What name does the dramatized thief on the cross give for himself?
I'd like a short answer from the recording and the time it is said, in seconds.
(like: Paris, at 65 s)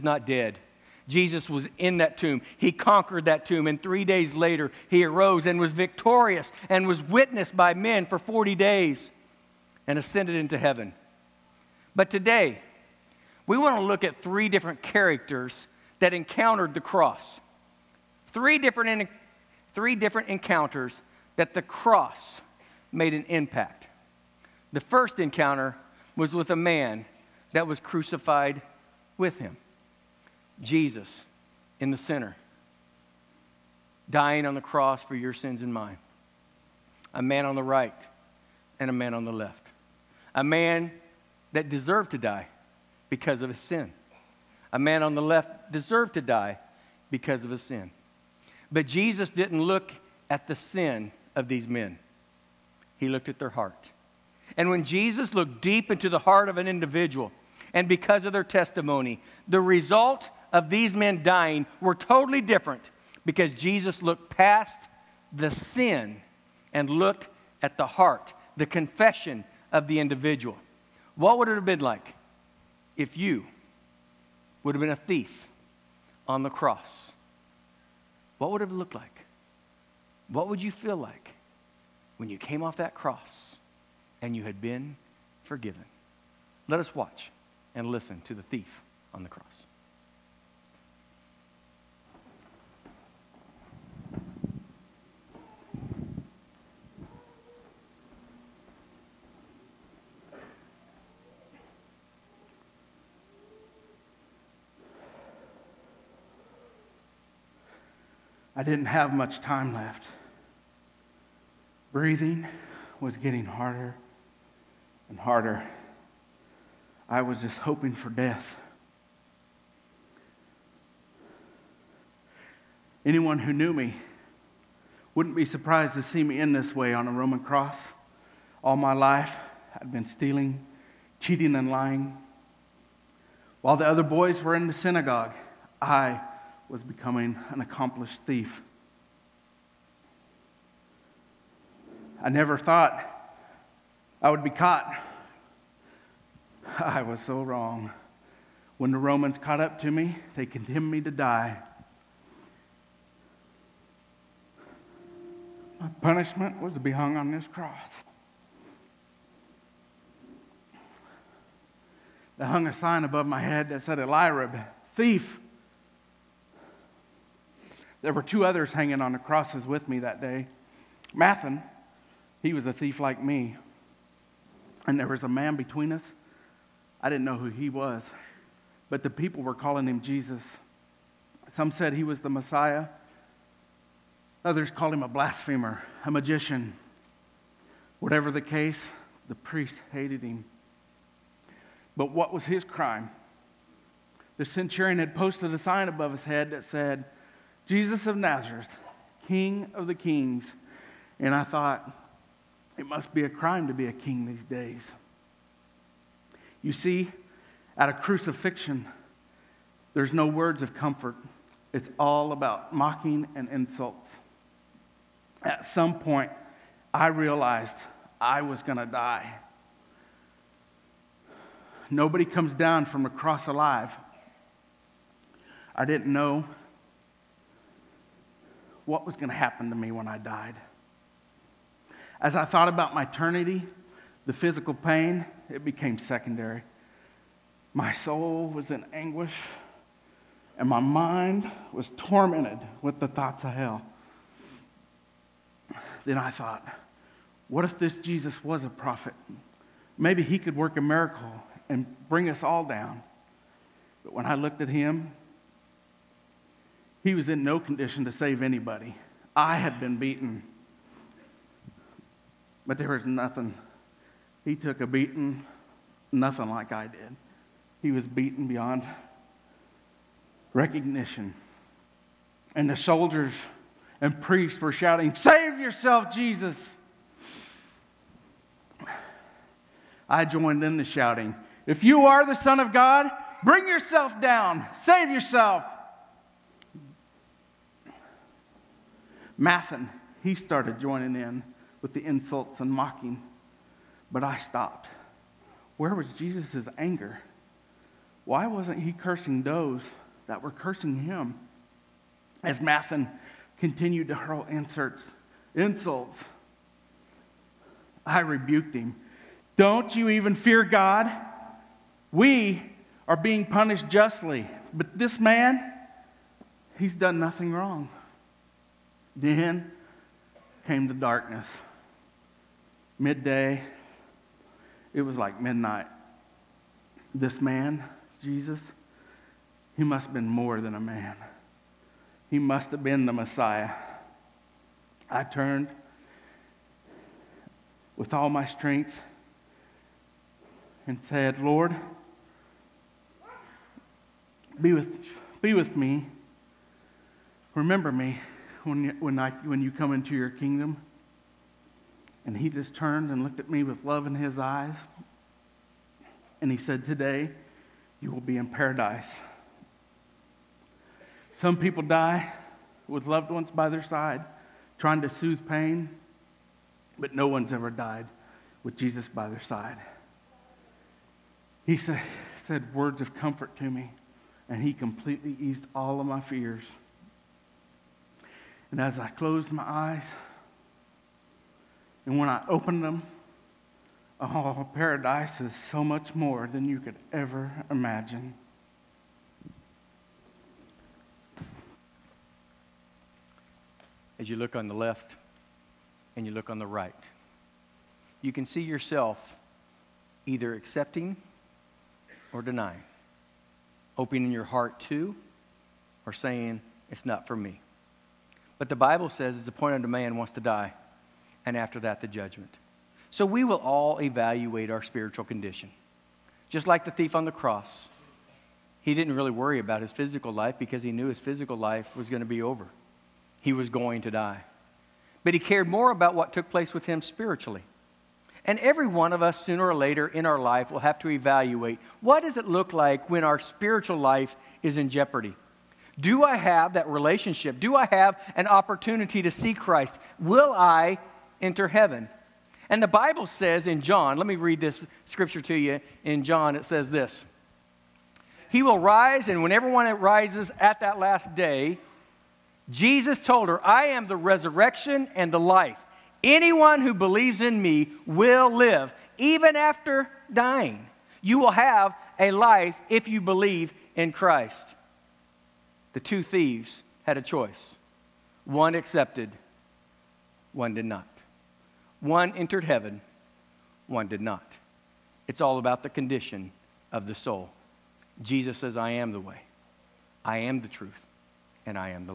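Elirib, at 163 s.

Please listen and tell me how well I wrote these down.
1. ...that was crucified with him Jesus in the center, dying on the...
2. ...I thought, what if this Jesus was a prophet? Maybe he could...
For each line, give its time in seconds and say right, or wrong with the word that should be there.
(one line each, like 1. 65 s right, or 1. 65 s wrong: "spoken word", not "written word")
1. 27 s right
2. 246 s right.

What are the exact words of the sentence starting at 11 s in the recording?
But today, we want to look at three different characters that encountered the cross.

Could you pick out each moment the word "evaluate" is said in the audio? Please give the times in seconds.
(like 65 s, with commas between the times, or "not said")
414 s, 431 s.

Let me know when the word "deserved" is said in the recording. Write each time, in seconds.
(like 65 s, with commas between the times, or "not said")
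41 s, 45 s.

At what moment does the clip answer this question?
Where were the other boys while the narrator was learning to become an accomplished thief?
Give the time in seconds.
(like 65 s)
134 s.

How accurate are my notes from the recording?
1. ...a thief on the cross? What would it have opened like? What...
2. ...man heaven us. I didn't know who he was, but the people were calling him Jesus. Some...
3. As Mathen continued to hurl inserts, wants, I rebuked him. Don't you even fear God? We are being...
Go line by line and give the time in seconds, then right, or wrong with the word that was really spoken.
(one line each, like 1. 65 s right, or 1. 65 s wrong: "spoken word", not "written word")
1. 74 s wrong: "looked", not "opened"
2. 175 s wrong: "between", not "heaven"
3. 302 s wrong: "insults", not "wants".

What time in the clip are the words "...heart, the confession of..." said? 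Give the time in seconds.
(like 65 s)
67 s.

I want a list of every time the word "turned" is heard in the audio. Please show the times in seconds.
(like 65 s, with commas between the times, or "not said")
335 s, 352 s.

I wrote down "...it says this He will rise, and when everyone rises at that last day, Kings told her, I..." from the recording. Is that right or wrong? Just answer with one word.
wrong.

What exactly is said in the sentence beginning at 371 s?
He sa- said words of comfort to me, and he completely eased all of my fears.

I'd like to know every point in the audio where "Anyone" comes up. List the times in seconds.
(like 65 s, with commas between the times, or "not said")
123 s, 456 s.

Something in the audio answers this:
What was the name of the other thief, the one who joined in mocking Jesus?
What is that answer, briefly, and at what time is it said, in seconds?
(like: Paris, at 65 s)
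Mathan, at 171 s.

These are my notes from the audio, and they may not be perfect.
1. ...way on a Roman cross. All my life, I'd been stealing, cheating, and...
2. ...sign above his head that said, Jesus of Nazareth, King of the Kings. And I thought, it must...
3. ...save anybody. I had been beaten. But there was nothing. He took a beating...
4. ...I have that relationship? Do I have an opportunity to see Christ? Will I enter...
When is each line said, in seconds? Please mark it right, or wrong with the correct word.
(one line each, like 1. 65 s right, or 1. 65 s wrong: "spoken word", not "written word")
1. 126 s right
2. 195 s right
3. 258 s right
4. 436 s right.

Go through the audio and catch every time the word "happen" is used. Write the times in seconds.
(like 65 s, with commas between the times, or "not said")
229 s.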